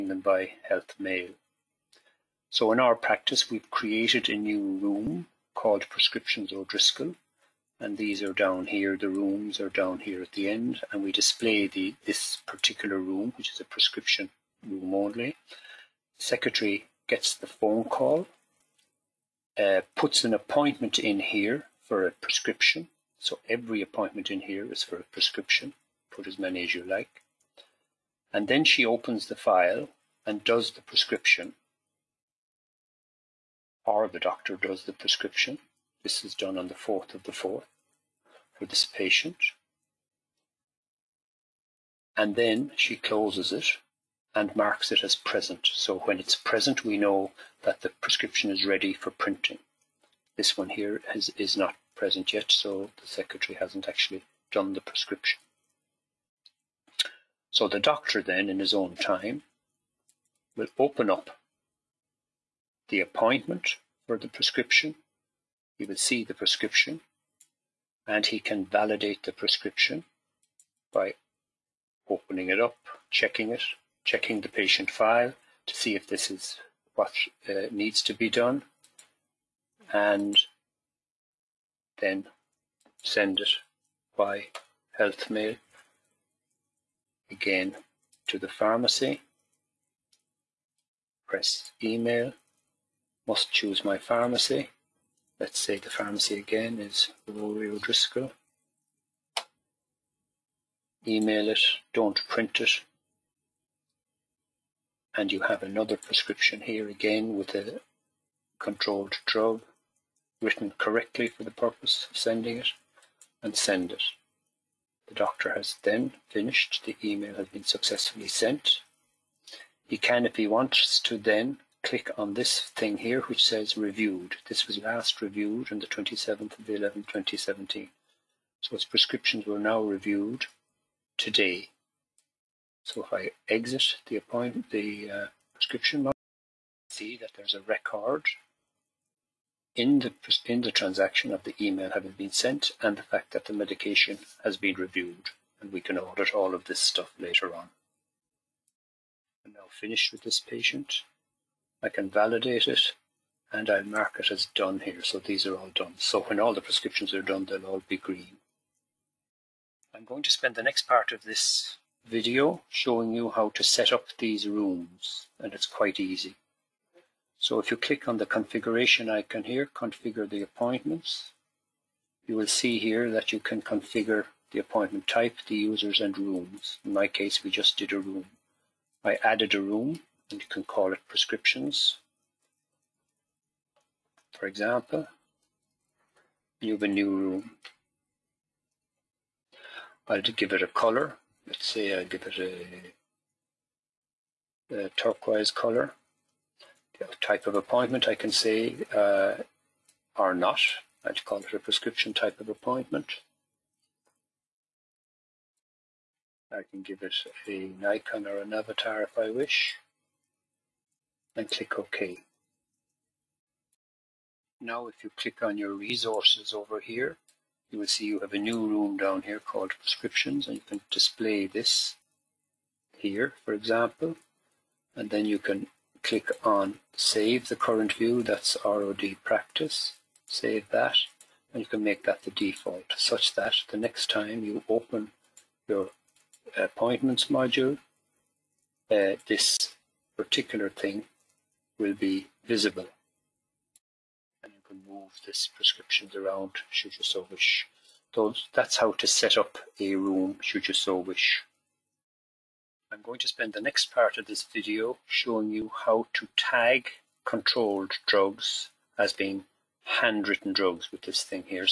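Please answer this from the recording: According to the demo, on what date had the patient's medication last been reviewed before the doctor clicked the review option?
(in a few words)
27/11/2017.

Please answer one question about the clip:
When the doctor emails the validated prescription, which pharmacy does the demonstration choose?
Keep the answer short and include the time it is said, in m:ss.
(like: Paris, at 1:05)
Rory O'Driscoll, at 1:37.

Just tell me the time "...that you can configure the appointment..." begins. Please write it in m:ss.
2:53.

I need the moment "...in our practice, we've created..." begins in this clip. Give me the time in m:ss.
0:02.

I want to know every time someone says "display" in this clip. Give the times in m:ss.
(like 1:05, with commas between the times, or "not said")
0:11, 3:40.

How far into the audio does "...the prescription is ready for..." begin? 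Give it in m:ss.
0:47.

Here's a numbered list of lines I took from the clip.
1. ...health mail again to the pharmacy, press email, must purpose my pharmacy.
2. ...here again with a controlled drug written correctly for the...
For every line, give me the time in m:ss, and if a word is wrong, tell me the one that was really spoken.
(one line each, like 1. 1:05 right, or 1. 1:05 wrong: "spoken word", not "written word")
1. 1:24 wrong: "choose", not "purpose"
2. 1:46 right.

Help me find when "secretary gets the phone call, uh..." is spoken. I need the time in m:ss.
0:16.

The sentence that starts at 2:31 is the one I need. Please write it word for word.
I can validate it and I'll mark it as done here.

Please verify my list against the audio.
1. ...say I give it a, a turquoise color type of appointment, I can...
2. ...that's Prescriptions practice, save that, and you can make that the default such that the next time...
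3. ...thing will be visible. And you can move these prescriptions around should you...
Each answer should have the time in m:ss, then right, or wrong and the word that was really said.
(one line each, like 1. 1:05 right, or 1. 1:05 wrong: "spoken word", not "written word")
1. 3:11 right
2. 3:48 wrong: "ROD", not "Prescriptions"
3. 4:00 right.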